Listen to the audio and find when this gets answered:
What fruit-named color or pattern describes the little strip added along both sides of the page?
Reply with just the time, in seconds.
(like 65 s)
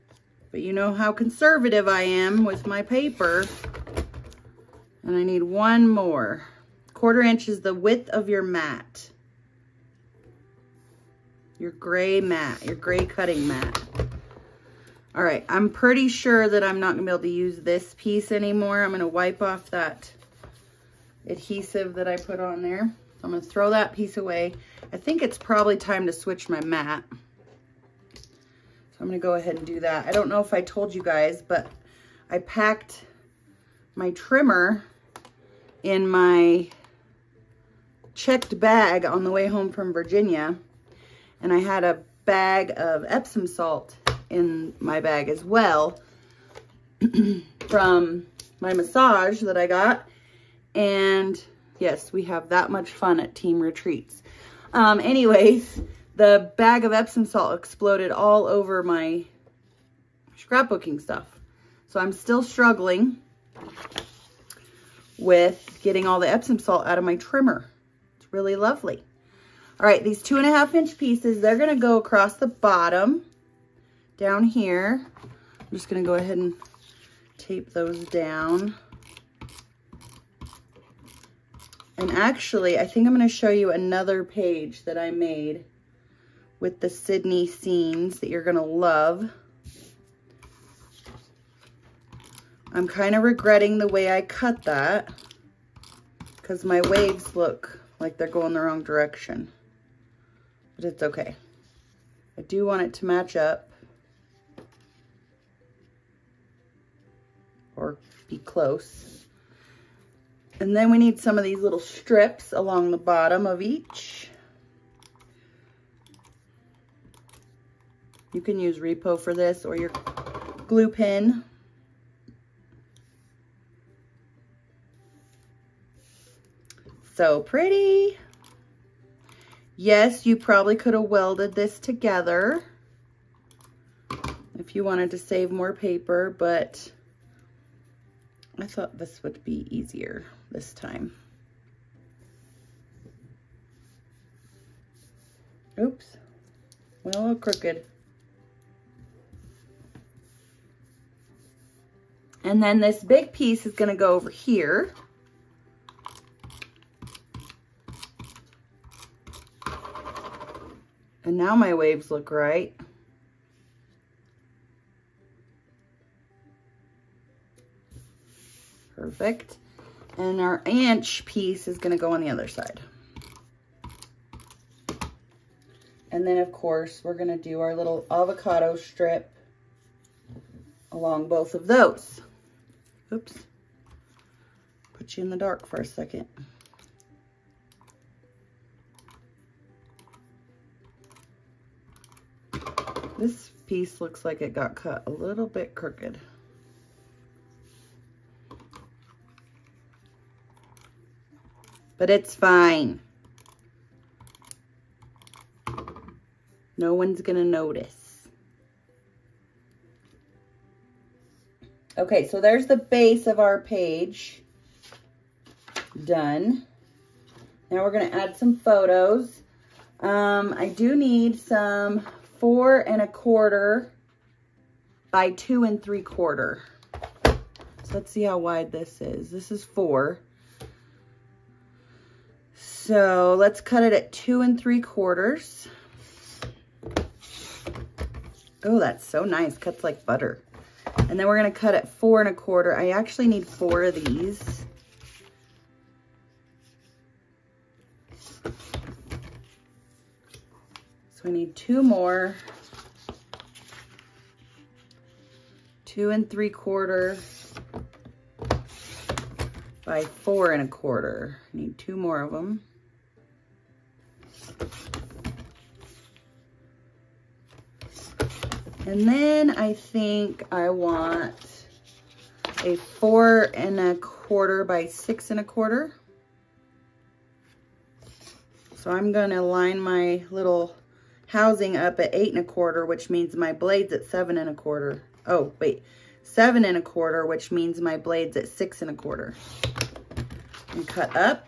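178 s.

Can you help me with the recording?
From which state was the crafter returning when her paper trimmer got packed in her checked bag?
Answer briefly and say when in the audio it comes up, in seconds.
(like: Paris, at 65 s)
Virginia, at 39 s.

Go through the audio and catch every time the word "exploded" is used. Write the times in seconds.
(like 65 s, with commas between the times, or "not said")
57 s.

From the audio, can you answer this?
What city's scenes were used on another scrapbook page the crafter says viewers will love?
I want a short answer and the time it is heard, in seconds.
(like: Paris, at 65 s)
Sydney, at 86 s.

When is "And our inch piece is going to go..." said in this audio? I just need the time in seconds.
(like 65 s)
170 s.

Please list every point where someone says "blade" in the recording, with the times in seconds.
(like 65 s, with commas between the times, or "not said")
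283 s, 287 s.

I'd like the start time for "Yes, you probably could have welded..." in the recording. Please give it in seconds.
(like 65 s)
129 s.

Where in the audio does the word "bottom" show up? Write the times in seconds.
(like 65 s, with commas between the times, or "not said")
72 s, 112 s.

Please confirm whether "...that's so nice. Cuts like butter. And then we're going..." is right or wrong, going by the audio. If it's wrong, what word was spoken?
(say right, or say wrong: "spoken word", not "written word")
right.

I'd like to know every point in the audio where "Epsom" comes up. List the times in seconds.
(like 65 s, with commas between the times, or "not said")
43 s, 56 s, 66 s.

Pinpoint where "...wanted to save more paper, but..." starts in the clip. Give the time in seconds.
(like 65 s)
134 s.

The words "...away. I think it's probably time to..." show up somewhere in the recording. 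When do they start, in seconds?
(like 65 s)
24 s.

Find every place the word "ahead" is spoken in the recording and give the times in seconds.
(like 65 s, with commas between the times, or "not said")
29 s, 76 s.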